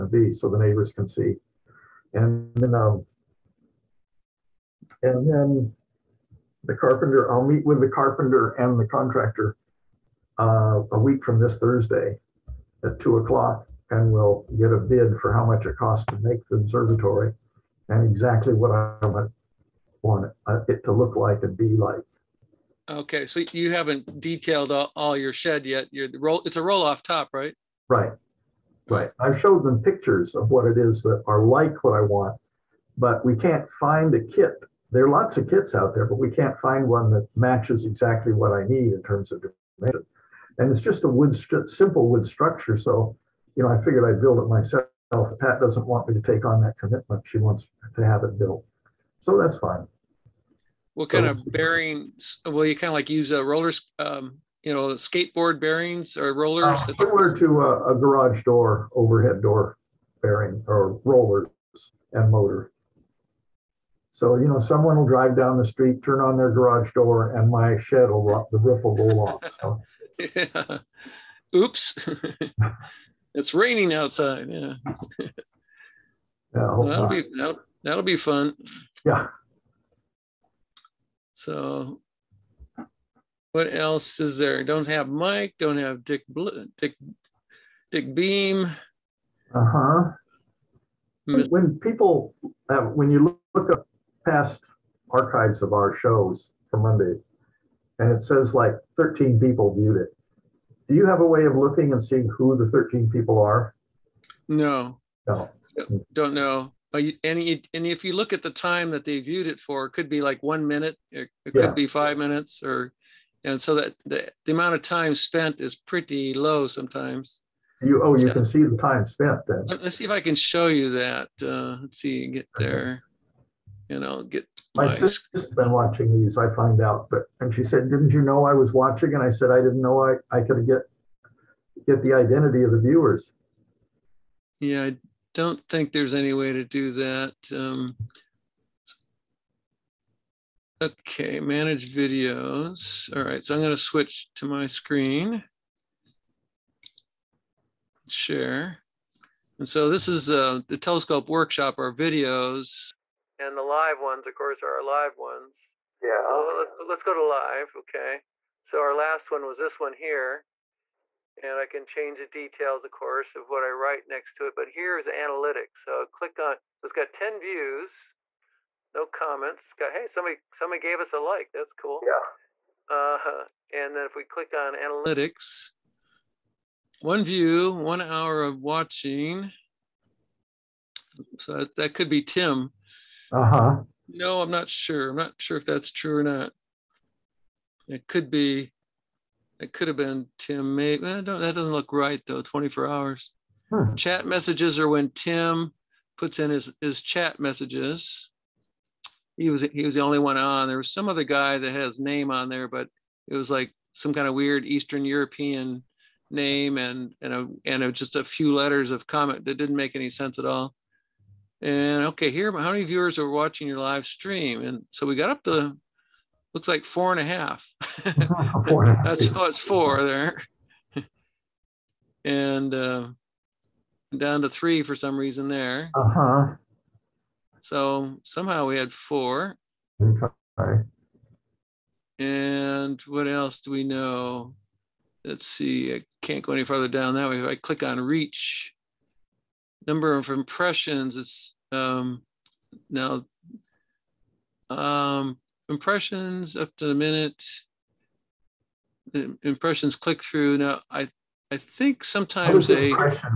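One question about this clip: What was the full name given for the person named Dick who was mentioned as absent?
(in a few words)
Dick Beam.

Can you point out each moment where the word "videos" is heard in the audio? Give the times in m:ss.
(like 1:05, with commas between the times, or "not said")
2:21, 2:31.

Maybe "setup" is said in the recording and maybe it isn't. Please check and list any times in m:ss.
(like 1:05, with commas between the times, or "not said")
not said.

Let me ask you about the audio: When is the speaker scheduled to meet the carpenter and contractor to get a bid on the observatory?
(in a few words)
Thursday at 2:00.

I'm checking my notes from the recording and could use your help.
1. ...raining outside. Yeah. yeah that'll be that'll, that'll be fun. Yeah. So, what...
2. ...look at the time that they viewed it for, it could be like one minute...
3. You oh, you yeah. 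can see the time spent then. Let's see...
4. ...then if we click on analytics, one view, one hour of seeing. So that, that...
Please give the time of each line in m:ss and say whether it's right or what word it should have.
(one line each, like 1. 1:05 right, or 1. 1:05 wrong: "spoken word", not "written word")
1. 1:13 right
2. 1:48 right
3. 1:57 right
4. 2:53 wrong: "watching", not "seeing".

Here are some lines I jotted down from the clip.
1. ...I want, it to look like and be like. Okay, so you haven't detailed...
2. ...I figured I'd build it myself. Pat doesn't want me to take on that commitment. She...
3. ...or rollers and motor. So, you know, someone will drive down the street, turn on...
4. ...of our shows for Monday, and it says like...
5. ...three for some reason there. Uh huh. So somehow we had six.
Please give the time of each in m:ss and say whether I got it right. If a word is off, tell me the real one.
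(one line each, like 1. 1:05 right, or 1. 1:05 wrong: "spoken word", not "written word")
1. 0:18 right
2. 0:43 right
3. 1:00 right
4. 1:35 right
5. 3:44 wrong: "four", not "six".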